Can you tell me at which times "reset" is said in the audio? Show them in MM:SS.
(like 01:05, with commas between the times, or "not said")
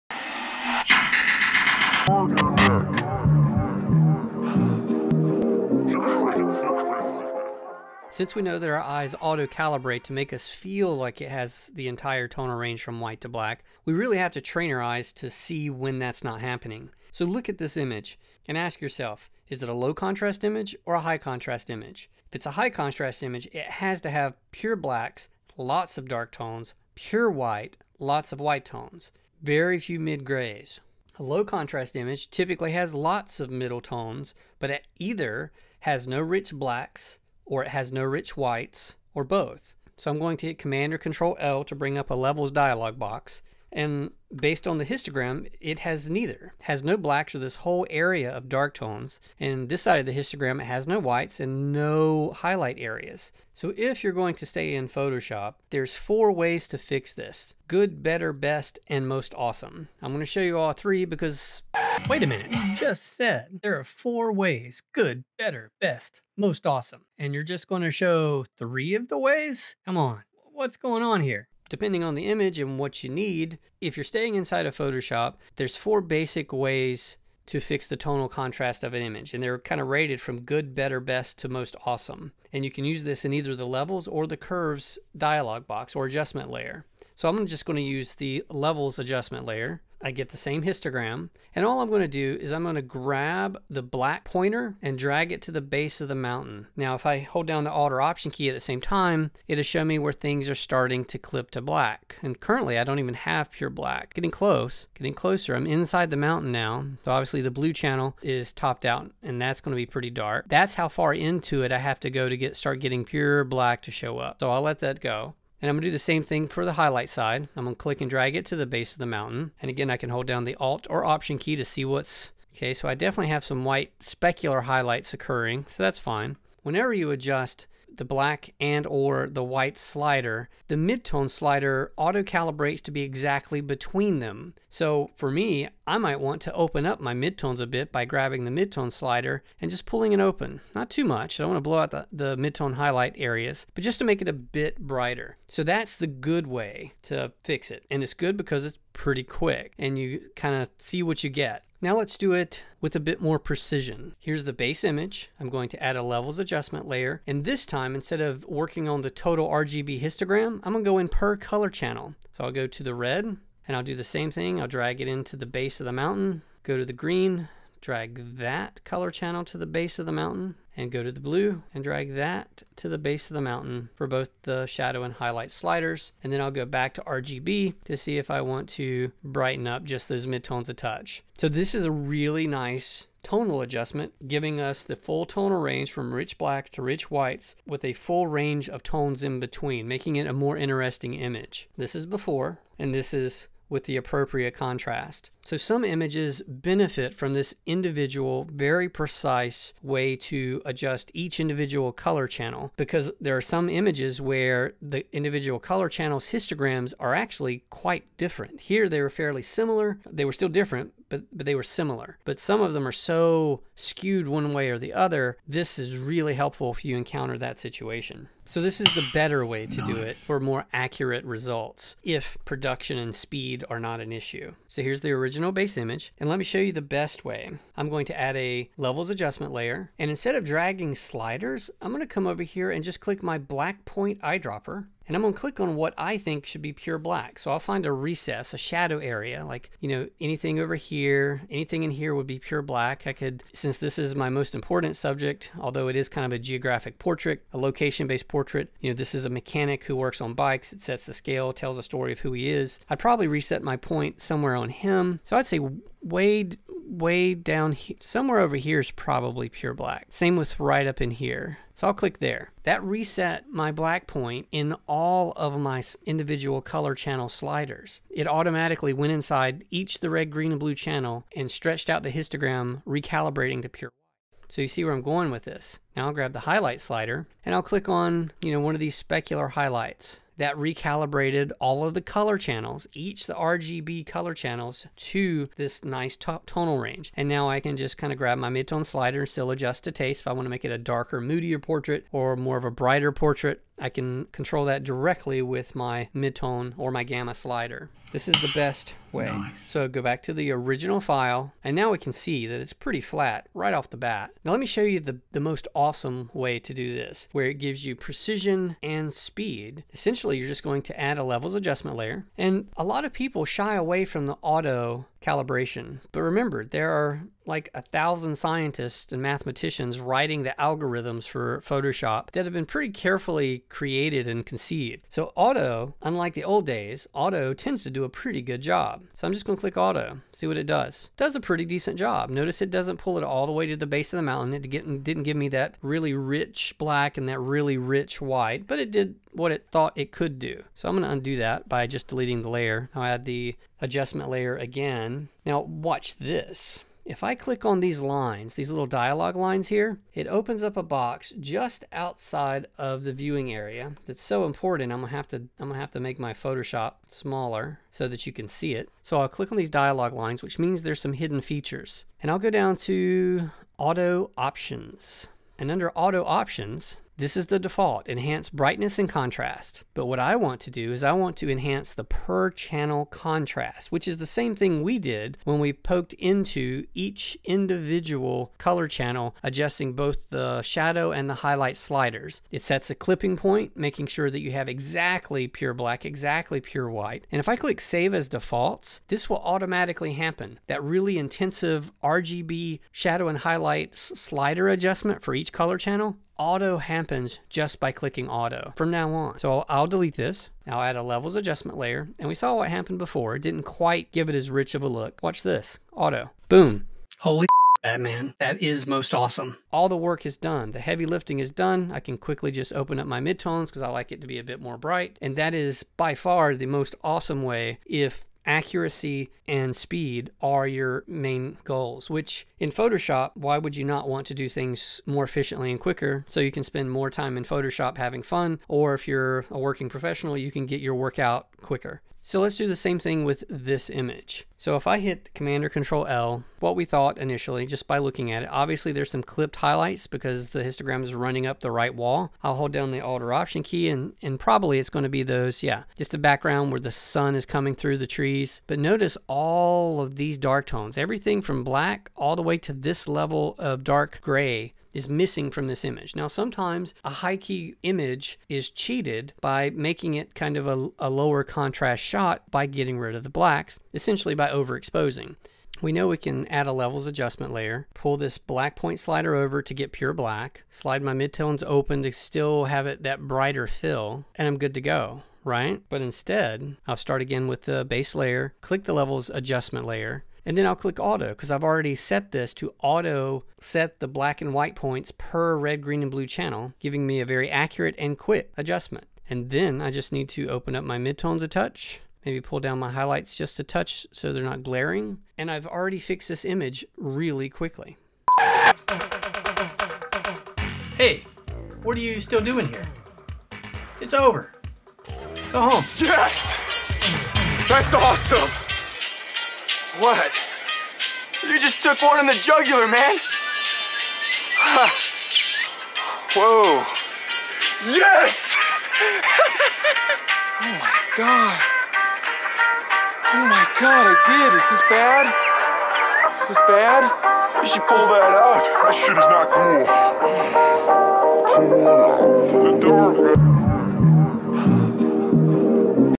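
04:13, 04:22.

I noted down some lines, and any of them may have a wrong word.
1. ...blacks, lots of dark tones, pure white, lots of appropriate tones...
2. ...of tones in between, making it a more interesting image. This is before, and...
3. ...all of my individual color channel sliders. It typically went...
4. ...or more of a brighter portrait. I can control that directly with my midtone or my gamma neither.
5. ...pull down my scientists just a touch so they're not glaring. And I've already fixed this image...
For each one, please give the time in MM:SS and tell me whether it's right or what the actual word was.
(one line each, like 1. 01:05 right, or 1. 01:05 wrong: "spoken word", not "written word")
1. 00:24 wrong: "white", not "appropriate"
2. 03:08 right
3. 04:24 wrong: "automatically", not "typically"
4. 04:52 wrong: "slider", not "neither"
5. 08:12 wrong: "highlights", not "scientists".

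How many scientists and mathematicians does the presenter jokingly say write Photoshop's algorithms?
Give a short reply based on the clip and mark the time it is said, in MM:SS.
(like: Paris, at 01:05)
1000, at 05:17.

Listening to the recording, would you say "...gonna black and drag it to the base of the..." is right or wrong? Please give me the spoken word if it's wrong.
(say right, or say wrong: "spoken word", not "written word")
wrong: "click", not "black".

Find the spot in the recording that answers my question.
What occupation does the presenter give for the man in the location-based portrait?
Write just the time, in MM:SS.
04:09.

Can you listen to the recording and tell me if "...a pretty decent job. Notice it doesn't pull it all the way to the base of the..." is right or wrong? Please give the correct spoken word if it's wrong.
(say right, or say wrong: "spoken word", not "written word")
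right.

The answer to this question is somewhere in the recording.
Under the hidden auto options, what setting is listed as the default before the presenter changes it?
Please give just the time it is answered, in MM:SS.
06:08.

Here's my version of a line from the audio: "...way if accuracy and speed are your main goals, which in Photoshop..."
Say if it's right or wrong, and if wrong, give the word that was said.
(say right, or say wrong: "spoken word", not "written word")
right.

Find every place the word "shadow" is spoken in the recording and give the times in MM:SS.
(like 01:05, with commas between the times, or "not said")
02:54, 03:58, 06:20, 06:32.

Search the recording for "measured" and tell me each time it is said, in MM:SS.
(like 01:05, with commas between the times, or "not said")
not said.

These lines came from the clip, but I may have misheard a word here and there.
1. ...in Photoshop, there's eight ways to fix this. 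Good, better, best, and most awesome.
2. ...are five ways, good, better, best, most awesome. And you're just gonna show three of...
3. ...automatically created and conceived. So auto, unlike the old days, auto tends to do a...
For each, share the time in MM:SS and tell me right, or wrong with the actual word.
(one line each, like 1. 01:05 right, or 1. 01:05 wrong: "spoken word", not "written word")
1. 00:54 wrong: "four", not "eight"
2. 01:03 wrong: "four", not "five"
3. 05:22 wrong: "carefully", not "automatically".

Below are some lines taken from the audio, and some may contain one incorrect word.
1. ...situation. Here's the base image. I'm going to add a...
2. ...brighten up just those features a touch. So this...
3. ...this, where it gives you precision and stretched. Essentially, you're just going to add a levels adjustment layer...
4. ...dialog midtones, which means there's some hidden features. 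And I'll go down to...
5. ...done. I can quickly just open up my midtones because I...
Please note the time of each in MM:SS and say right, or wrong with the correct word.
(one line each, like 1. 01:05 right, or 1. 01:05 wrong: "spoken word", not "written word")
1. 02:33 wrong: "precision", not "situation"
2. 02:59 wrong: "midtones", not "features"
3. 05:06 wrong: "speed", not "stretched"
4. 05:59 wrong: "lines", not "midtones"
5. 06:51 right.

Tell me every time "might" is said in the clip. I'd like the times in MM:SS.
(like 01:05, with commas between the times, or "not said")
02:15.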